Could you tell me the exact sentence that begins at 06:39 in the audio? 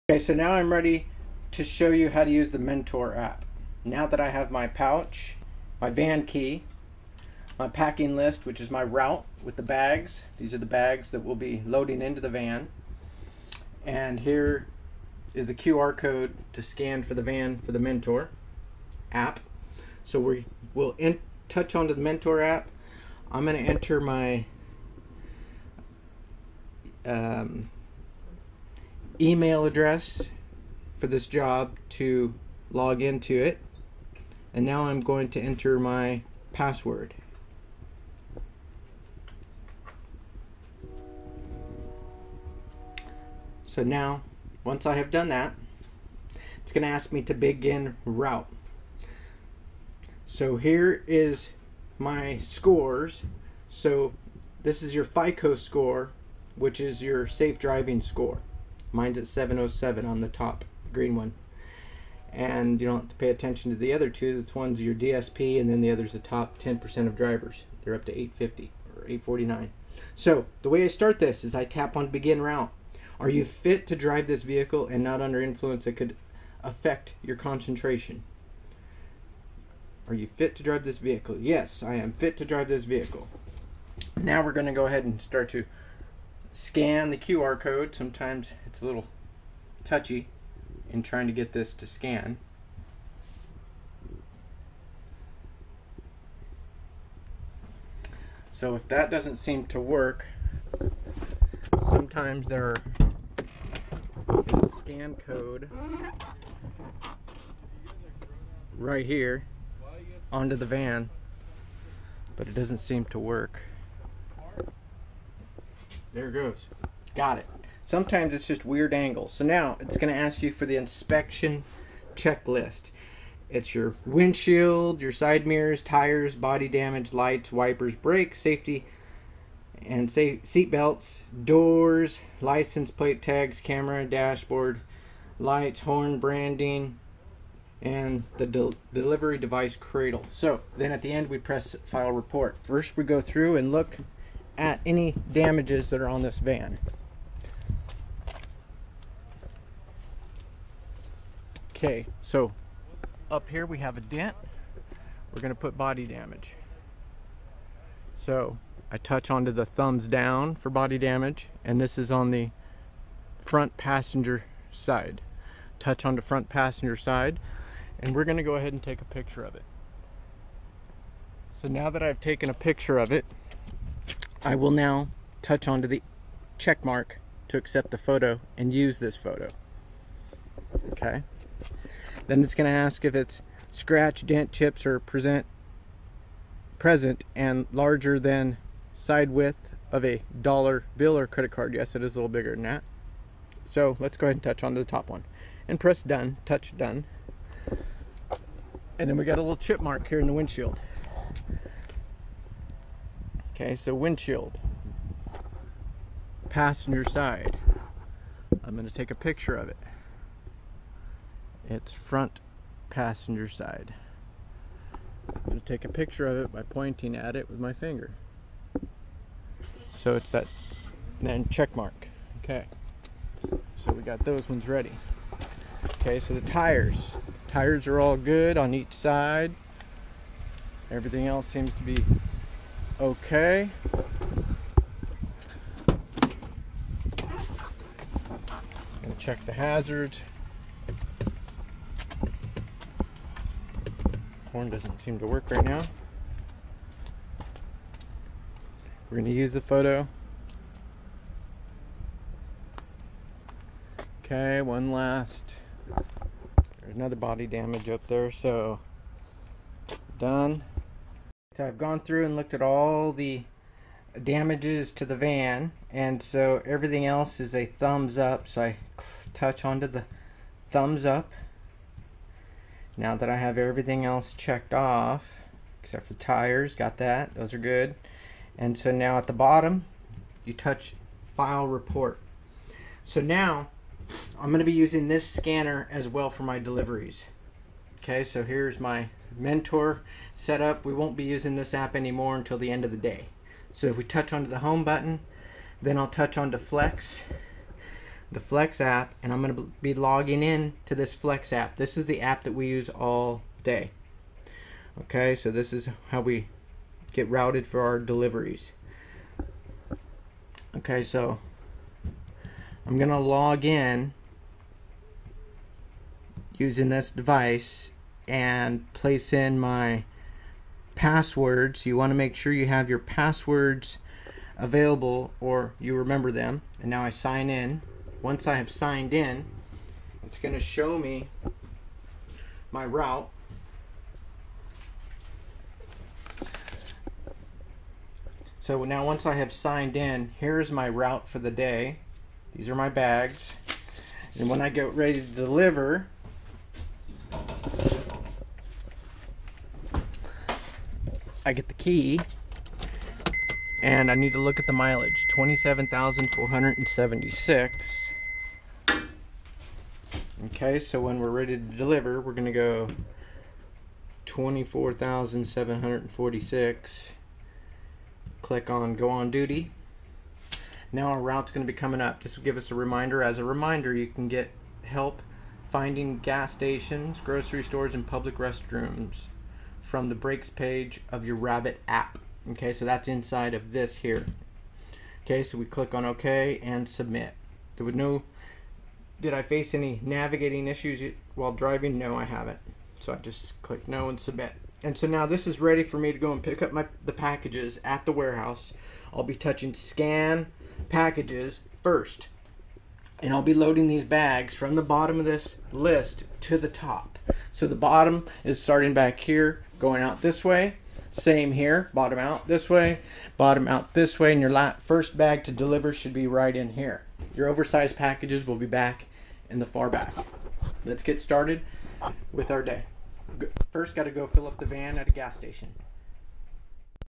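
I'll be touching scan packages first.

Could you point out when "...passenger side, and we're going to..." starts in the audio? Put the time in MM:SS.
02:46.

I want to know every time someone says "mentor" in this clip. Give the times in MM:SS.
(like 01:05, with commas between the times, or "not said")
00:02, 00:17, 00:22, 04:49.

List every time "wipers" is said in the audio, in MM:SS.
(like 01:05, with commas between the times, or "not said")
02:07.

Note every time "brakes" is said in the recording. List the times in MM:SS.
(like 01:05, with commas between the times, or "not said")
02:07.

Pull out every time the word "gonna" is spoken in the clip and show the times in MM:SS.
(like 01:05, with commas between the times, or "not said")
00:46, 04:09, 06:02, 06:11.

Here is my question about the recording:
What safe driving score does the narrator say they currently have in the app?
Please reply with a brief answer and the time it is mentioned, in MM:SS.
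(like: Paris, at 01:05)
707, at 00:59.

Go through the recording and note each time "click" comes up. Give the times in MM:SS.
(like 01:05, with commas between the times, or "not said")
06:08, 06:25, 06:33.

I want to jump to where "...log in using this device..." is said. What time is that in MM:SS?
05:13.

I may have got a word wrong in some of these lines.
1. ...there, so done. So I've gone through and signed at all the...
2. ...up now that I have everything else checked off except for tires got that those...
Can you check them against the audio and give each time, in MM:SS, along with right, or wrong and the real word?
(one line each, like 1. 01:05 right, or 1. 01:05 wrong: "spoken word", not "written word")
1. 04:18 wrong: "looked", not "signed"
2. 04:31 right.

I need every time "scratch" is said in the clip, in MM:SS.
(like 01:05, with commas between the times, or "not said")
03:03.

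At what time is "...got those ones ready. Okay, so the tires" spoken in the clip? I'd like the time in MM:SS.
03:44.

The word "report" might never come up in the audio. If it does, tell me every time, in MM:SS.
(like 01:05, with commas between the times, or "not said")
02:22, 04:41.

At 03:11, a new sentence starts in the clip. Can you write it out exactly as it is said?
Yes, it is a little bigger than that.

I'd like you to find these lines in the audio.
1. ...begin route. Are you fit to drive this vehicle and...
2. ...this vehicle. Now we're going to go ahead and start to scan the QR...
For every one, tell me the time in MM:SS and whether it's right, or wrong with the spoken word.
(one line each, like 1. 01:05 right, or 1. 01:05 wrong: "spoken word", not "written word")
1. 01:12 right
2. 01:22 right.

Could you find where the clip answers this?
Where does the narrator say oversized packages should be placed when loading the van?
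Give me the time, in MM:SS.
06:59.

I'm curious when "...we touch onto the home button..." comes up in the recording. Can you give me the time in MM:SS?
04:53.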